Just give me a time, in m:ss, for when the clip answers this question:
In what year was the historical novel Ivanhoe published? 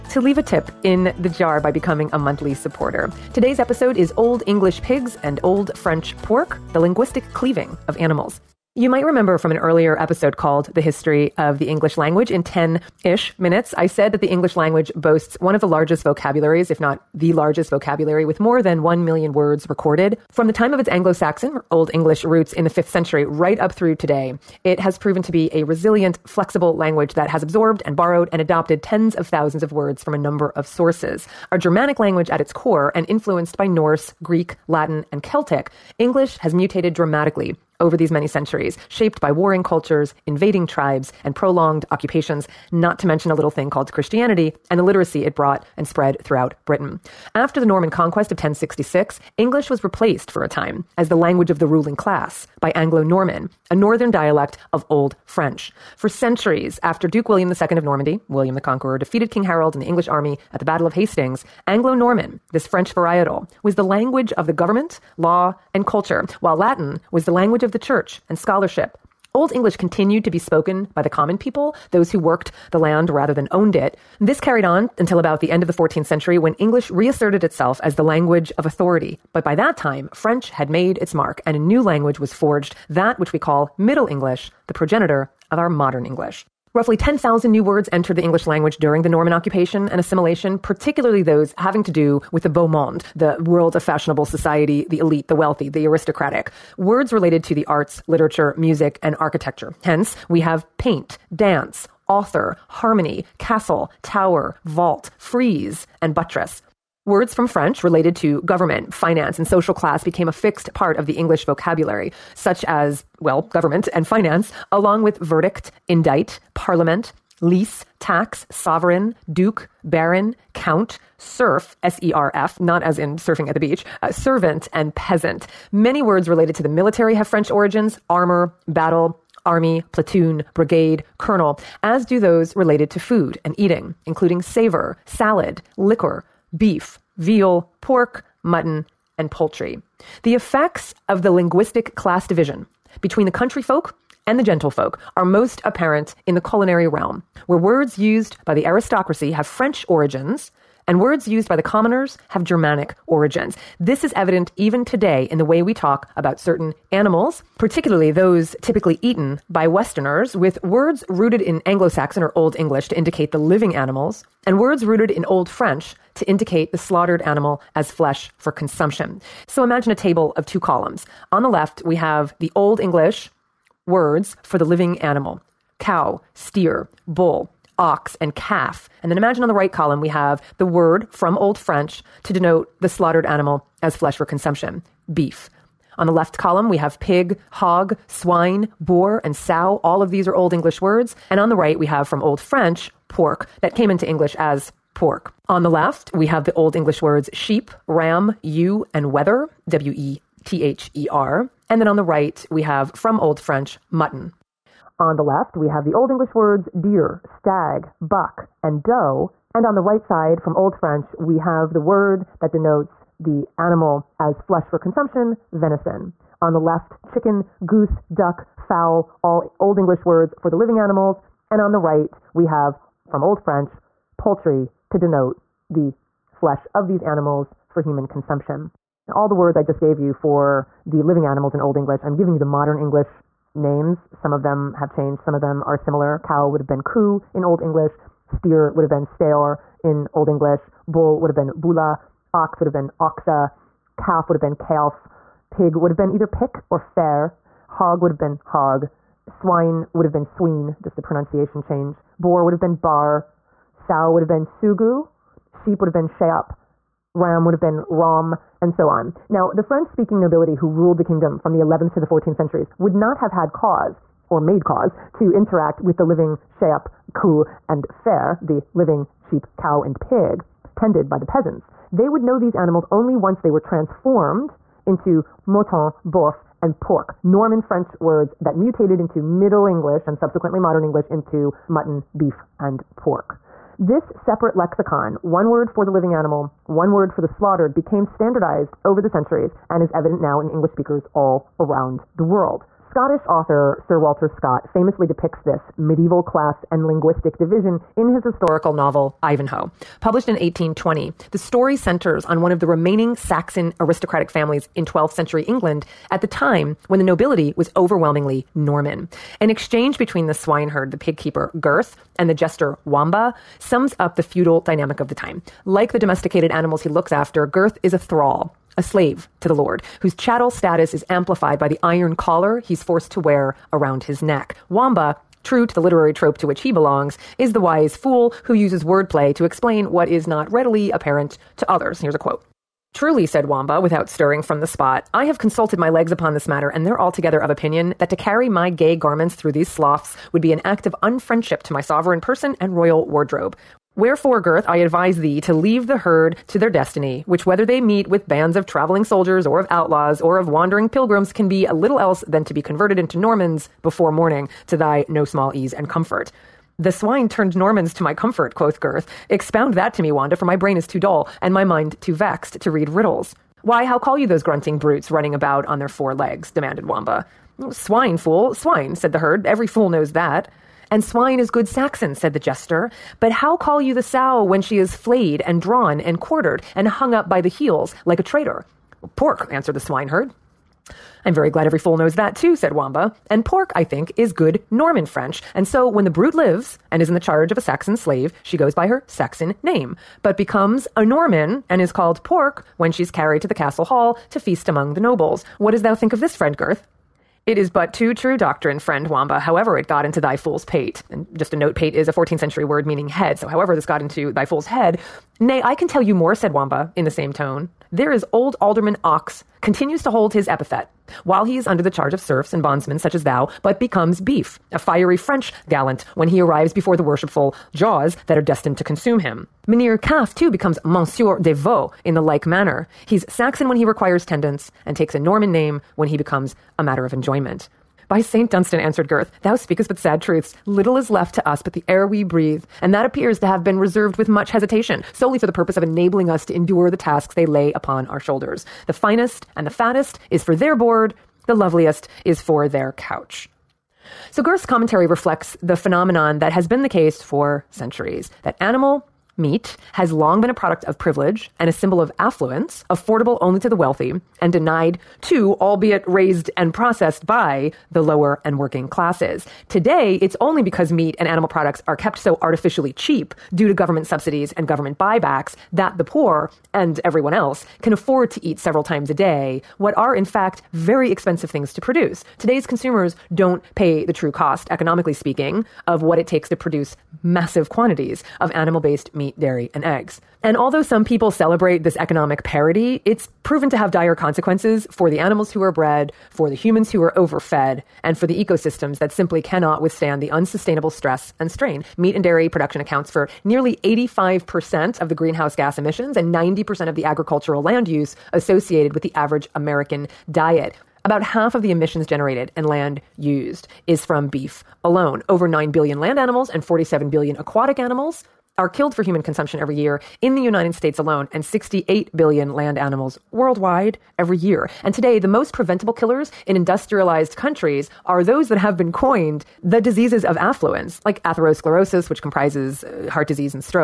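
5:00.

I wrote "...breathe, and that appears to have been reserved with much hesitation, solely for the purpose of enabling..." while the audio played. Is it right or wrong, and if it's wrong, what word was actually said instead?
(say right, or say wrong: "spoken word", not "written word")
right.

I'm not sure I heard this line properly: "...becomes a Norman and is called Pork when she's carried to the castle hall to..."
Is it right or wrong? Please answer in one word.
right.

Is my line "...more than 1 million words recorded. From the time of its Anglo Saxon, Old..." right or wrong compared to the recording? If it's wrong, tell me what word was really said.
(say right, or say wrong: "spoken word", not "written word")
right.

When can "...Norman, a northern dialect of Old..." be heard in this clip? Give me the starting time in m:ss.
0:53.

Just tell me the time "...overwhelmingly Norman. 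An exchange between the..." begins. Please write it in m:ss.
5:07.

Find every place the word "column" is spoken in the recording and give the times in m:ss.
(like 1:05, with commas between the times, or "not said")
2:50, 2:59, 3:06.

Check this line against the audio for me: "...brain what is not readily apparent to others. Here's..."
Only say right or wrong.
wrong.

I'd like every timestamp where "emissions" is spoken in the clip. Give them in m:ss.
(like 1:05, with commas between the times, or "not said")
8:15, 8:21.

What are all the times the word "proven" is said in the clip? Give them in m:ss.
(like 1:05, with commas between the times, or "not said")
0:24, 8:03.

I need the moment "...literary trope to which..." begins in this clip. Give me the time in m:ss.
5:25.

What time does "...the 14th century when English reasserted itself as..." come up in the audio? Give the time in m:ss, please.
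1:15.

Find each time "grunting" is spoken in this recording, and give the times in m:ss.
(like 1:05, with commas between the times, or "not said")
6:04.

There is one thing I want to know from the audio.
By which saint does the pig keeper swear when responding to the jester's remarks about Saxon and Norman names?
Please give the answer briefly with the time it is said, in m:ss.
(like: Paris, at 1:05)
St. Dunstan, at 7:08.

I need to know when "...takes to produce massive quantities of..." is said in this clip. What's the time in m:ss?
7:56.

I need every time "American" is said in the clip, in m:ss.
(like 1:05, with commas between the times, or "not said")
8:19.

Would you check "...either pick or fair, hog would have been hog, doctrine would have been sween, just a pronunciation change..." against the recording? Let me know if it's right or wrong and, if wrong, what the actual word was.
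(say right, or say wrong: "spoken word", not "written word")
wrong: "swine", not "doctrine".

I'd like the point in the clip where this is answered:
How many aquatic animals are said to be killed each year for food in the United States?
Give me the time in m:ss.
8:26.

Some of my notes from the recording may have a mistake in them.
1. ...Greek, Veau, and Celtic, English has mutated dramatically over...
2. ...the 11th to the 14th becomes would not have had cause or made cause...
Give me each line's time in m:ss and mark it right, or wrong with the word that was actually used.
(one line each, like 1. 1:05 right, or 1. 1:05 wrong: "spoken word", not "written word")
1. 0:34 wrong: "Latin", not "Veau"
2. 4:21 wrong: "centuries", not "becomes".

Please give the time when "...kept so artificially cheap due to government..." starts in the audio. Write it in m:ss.
7:41.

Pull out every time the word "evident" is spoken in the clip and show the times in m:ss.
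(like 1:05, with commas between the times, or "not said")
2:34, 4:49.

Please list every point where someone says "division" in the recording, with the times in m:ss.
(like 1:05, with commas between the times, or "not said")
2:22, 4:57.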